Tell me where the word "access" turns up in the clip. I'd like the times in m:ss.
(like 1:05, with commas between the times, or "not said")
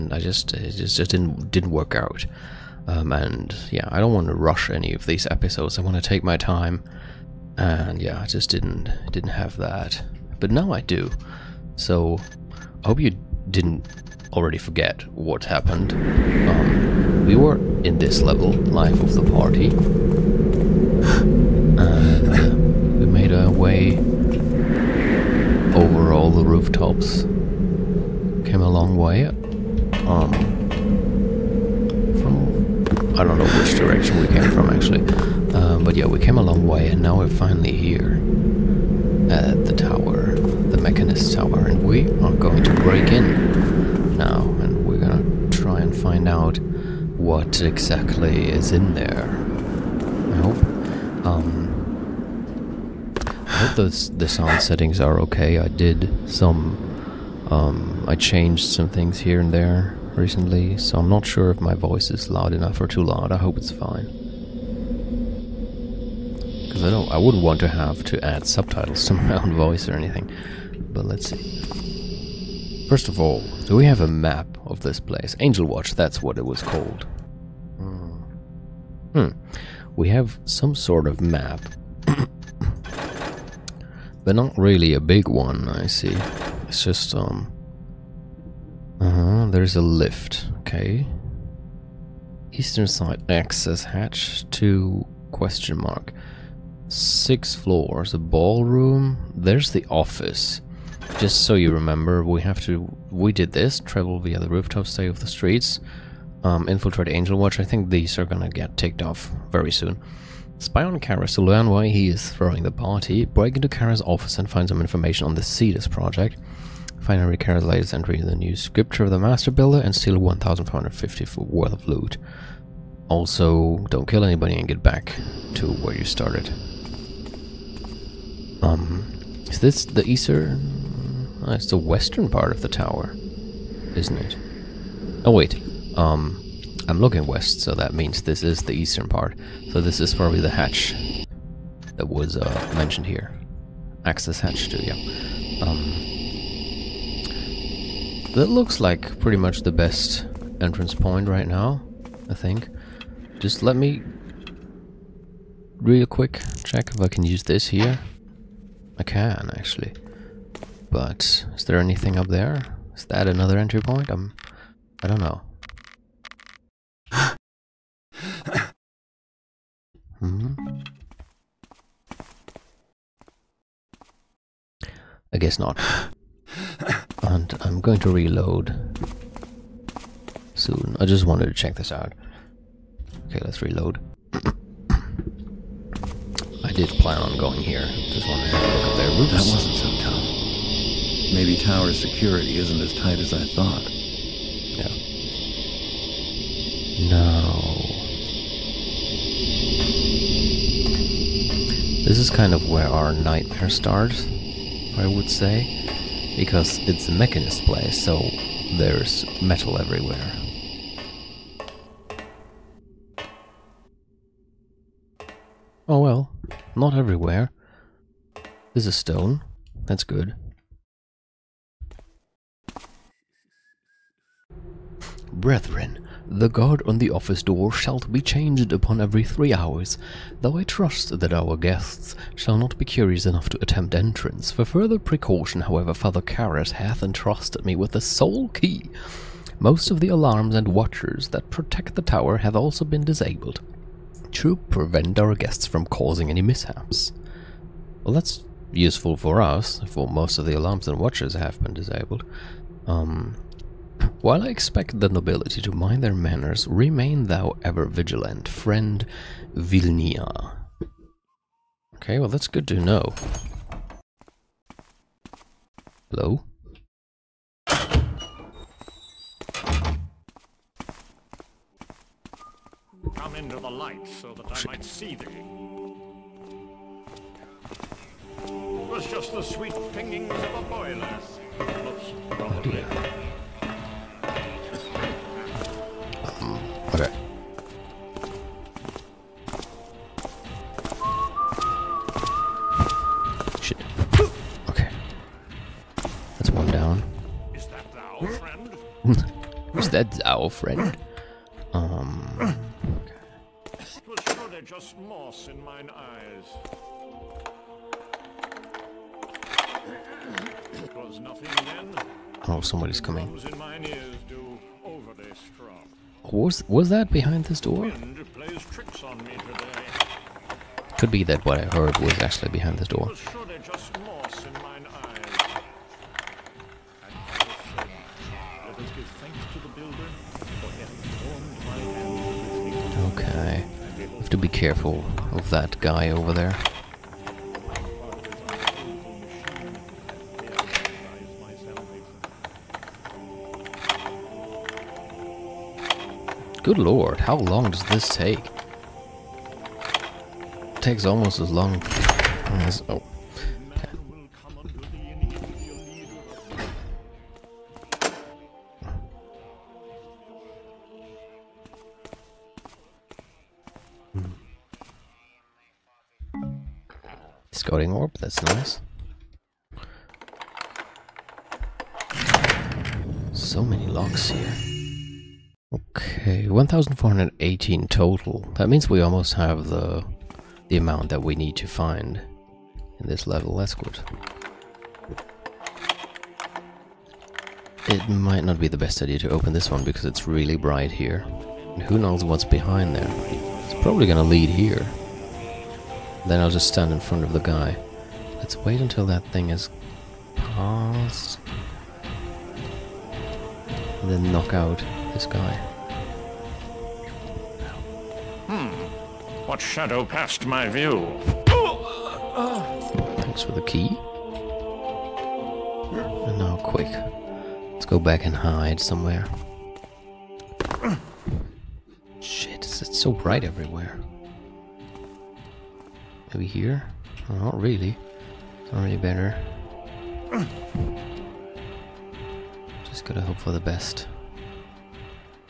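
1:33, 2:24.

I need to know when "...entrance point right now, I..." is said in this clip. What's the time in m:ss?
2:30.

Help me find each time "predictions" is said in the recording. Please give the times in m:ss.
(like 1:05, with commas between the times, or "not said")
not said.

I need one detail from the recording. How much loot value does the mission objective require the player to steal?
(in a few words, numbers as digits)
1,450.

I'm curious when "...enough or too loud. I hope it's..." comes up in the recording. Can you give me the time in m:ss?
1:02.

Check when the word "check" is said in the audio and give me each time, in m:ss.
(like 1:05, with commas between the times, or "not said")
2:36, 3:01.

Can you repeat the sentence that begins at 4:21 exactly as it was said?
Okay, well that's good to know.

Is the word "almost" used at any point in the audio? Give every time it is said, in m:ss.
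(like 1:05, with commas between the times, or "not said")
5:51, 6:19.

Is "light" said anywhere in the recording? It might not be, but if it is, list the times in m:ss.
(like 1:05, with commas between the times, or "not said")
4:33.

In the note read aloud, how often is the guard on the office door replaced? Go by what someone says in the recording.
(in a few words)
every three hours.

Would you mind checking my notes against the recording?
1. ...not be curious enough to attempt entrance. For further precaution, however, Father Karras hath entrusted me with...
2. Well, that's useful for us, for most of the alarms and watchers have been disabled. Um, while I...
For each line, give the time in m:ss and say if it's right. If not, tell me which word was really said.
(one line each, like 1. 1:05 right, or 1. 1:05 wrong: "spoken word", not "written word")
1. 3:52 right
2. 4:08 right.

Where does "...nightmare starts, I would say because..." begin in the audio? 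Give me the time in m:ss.
3:23.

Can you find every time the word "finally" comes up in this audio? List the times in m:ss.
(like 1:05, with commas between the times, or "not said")
0:37, 1:56.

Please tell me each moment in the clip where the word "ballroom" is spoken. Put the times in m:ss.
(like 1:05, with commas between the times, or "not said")
1:38.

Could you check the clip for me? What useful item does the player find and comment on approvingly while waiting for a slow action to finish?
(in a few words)
scouting orb.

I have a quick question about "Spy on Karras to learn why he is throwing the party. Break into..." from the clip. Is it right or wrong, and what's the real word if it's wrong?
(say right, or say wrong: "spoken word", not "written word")
right.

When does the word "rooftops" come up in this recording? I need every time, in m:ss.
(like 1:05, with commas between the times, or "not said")
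0:26, 1:44.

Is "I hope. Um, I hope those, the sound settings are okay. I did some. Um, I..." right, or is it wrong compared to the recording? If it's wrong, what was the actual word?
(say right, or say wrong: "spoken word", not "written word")
right.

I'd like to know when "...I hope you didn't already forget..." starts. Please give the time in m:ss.
0:12.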